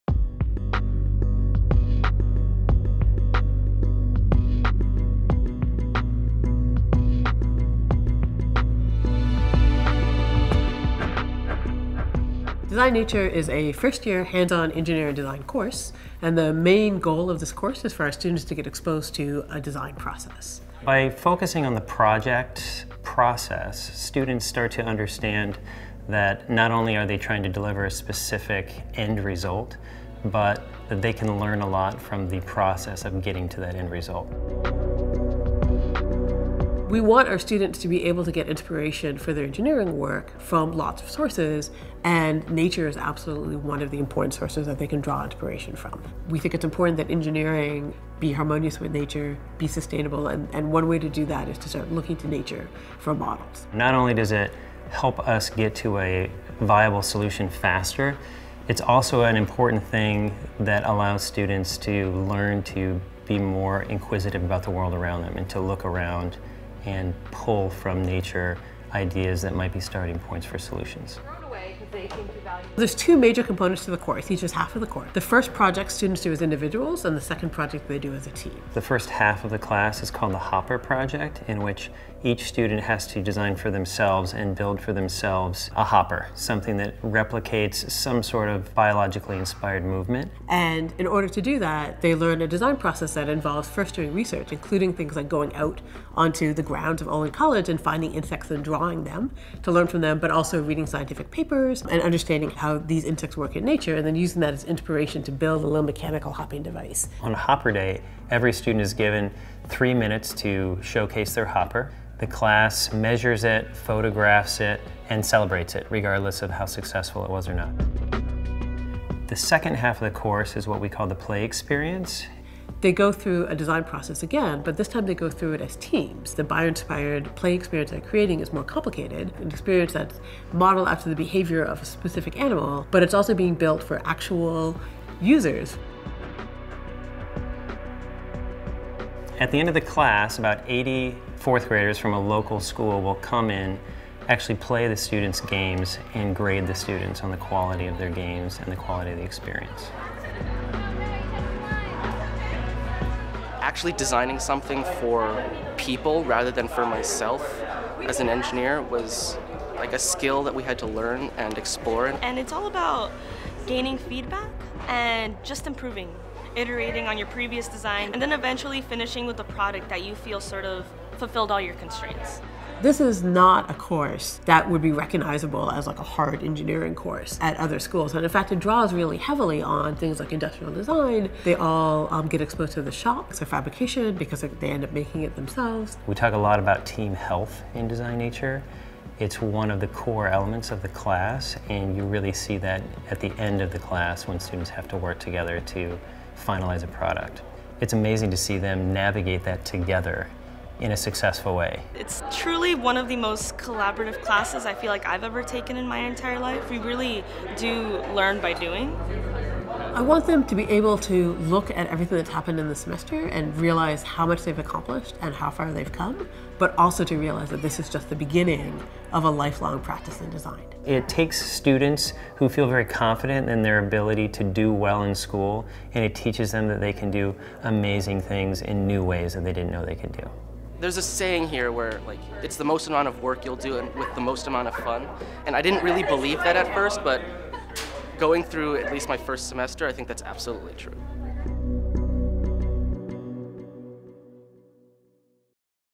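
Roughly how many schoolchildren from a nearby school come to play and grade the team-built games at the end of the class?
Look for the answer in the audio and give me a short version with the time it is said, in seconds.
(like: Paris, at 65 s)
80, at 140 s.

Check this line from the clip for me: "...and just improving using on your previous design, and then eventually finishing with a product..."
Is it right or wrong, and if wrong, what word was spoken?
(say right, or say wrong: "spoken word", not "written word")
wrong: "iterating", not "using".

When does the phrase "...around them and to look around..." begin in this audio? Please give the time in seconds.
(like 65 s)
64 s.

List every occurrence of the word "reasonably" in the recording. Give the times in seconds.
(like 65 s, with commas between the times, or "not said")
not said.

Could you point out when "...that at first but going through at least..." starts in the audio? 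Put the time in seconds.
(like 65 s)
236 s.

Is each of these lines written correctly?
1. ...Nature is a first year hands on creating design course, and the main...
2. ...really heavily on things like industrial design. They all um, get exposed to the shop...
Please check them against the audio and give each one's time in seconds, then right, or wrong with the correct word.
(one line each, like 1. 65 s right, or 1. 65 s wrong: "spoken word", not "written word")
1. 12 s wrong: "engineering", not "creating"
2. 178 s right.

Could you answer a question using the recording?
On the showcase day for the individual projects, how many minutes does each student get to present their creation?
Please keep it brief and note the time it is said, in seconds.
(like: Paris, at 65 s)
3, at 109 s.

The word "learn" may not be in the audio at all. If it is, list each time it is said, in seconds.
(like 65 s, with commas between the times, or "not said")
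31 s, 62 s, 92 s, 99 s, 160 s, 208 s.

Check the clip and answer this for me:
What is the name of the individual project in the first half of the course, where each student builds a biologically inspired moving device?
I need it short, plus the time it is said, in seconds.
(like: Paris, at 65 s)
Hopper Project, at 80 s.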